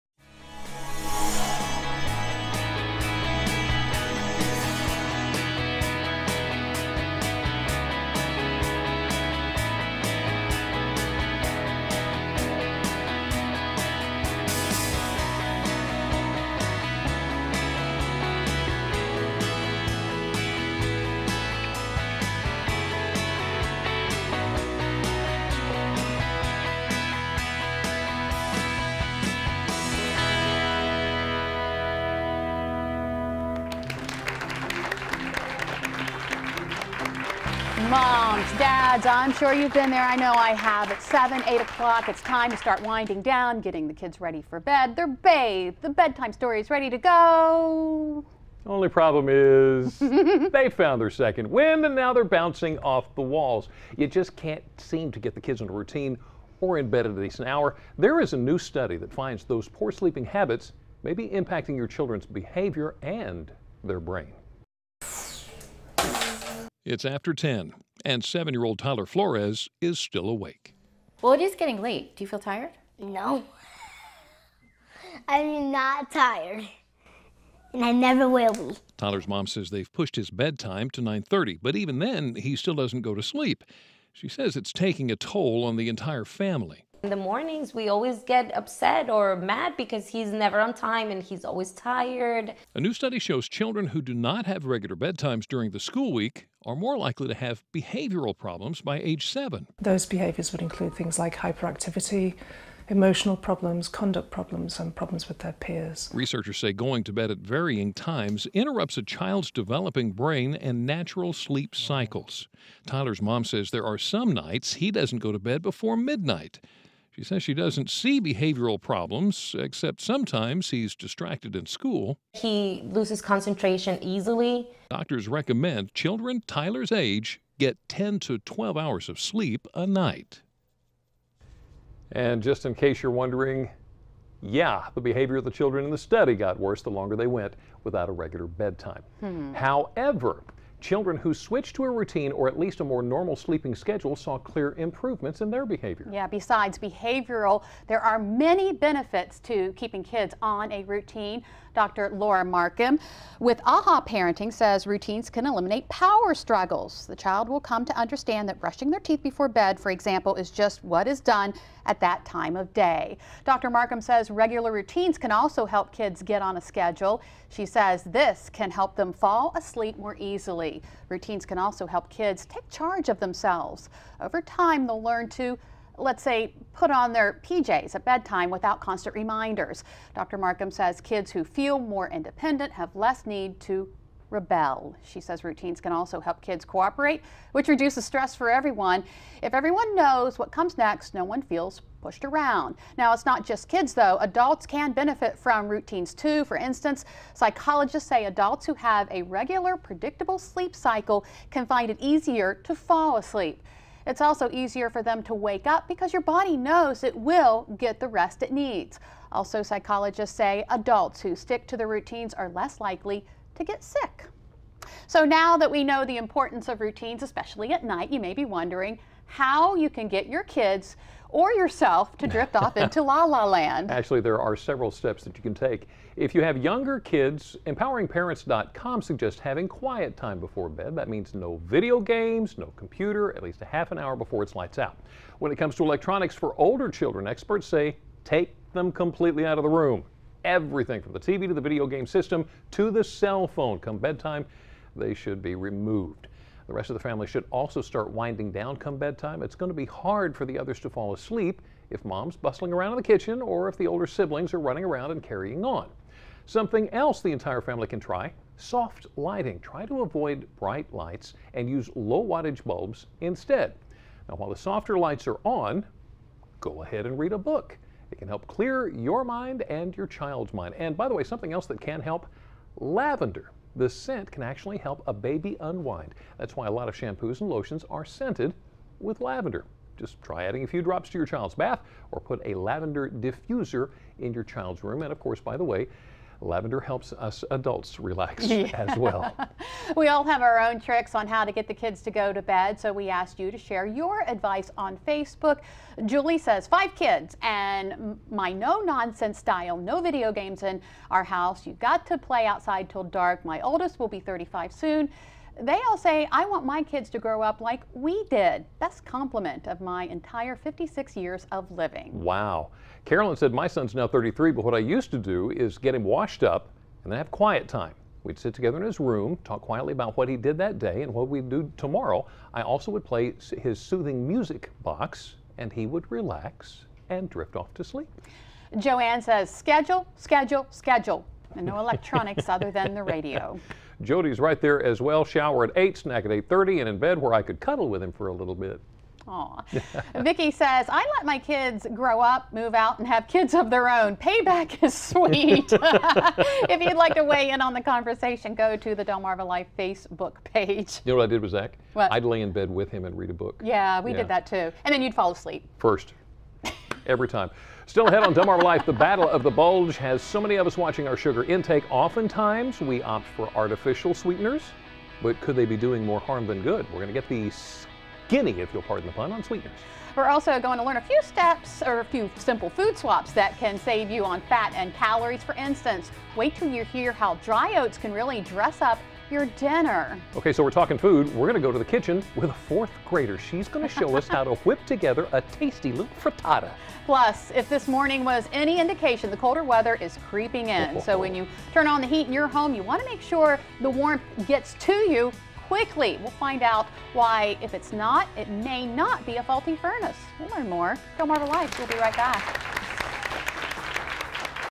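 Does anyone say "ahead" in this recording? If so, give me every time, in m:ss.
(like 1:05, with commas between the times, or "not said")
4:26, 5:58.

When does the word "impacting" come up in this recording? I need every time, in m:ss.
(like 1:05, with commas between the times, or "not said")
1:01.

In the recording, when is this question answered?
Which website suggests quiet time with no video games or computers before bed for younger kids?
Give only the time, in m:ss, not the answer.
3:47.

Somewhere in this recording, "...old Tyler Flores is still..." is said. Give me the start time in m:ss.
1:08.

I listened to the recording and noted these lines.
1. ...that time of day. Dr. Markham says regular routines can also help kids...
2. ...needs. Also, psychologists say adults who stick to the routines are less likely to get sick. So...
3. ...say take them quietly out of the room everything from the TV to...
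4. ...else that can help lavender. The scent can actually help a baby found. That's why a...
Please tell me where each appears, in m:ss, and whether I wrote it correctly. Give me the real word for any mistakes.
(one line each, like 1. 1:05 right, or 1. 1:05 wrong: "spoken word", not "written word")
1. 2:42 right
2. 3:28 right
3. 3:57 wrong: "completely", not "quietly"
4. 4:31 wrong: "unwind", not "found".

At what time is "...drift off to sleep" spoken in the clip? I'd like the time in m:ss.
5:27.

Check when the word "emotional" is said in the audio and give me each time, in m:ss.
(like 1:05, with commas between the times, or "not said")
1:42.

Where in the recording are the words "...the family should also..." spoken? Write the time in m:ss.
4:06.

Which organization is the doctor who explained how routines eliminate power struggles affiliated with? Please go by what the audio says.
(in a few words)
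AHA Parenting.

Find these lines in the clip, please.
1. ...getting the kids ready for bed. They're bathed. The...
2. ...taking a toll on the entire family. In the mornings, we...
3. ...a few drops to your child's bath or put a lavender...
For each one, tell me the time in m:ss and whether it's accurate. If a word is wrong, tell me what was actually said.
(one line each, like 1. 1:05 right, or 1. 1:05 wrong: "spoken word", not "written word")
1. 0:43 right
2. 1:24 right
3. 4:40 right.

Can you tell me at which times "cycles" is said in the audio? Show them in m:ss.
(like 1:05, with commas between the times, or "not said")
1:51, 3:20.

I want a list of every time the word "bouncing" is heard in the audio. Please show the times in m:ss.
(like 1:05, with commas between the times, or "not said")
0:52.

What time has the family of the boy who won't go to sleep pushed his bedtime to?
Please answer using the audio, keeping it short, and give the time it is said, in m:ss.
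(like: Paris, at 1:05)
9:30, at 1:21.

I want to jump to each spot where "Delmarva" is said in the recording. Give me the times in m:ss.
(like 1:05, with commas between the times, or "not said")
5:49, 5:58, 6:41.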